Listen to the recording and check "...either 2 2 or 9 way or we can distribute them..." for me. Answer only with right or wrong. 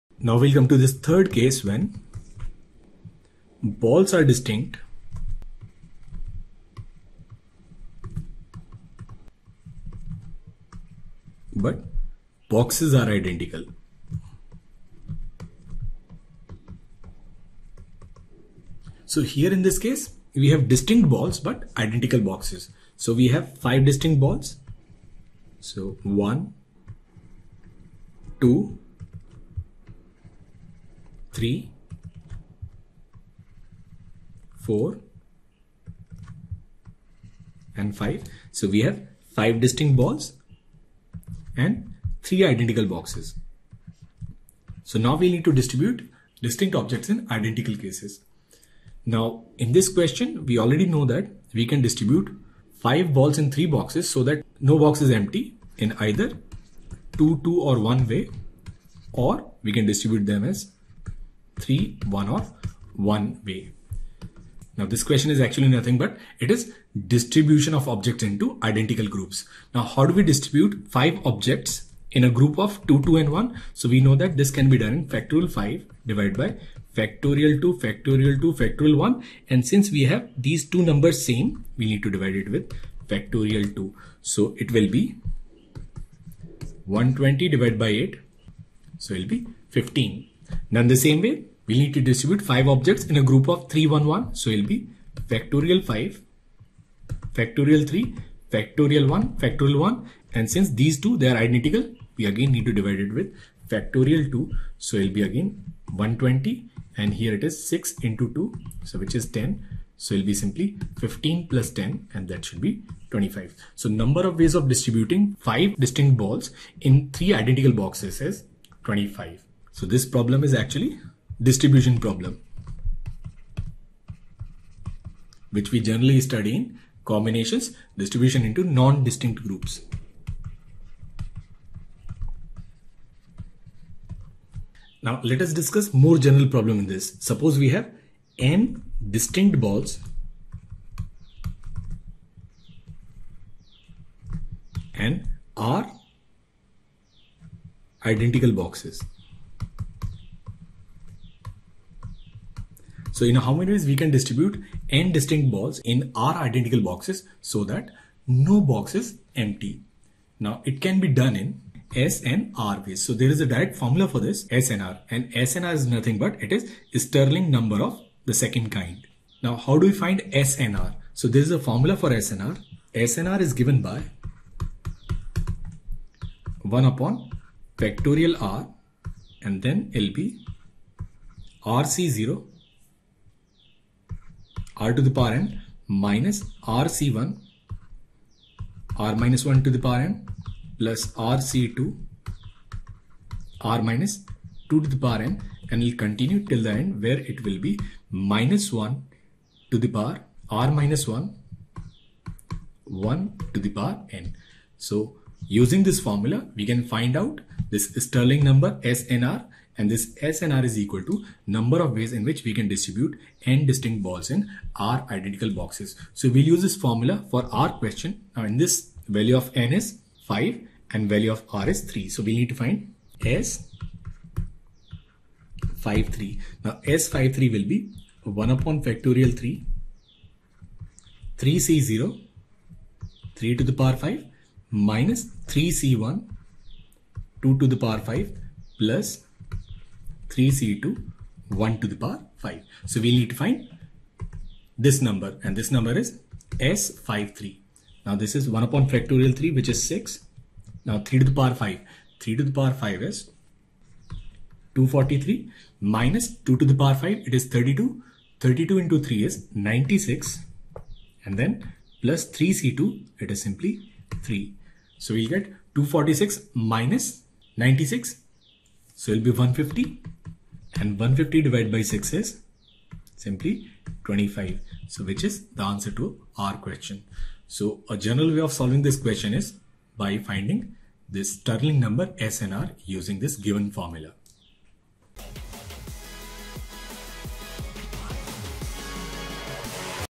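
wrong.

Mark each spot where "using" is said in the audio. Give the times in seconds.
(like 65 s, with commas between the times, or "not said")
205 s, 282 s.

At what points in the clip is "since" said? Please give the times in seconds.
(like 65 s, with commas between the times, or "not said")
79 s, 100 s.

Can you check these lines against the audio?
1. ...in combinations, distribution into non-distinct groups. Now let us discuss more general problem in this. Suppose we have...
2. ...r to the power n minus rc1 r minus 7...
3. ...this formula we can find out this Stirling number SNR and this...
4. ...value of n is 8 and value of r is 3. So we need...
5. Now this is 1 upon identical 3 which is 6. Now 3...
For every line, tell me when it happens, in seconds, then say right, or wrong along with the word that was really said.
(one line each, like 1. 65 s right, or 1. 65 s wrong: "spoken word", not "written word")
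1. 126 s right
2. 184 s wrong: "1", not "7"
3. 205 s right
4. 219 s wrong: "5", not "8"
5. 248 s wrong: "factorial", not "identical".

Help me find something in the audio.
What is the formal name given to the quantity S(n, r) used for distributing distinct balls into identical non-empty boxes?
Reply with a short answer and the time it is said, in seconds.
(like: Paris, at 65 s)
Stirling number of the second kind, at 167 s.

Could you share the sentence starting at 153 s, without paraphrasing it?
So in how many ways we can distribute n distinct balls in r identical boxes so that no box is empty.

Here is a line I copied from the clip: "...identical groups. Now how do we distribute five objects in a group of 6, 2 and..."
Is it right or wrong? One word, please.
wrong.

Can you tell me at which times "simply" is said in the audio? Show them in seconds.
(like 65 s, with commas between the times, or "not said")
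110 s, 263 s, 273 s.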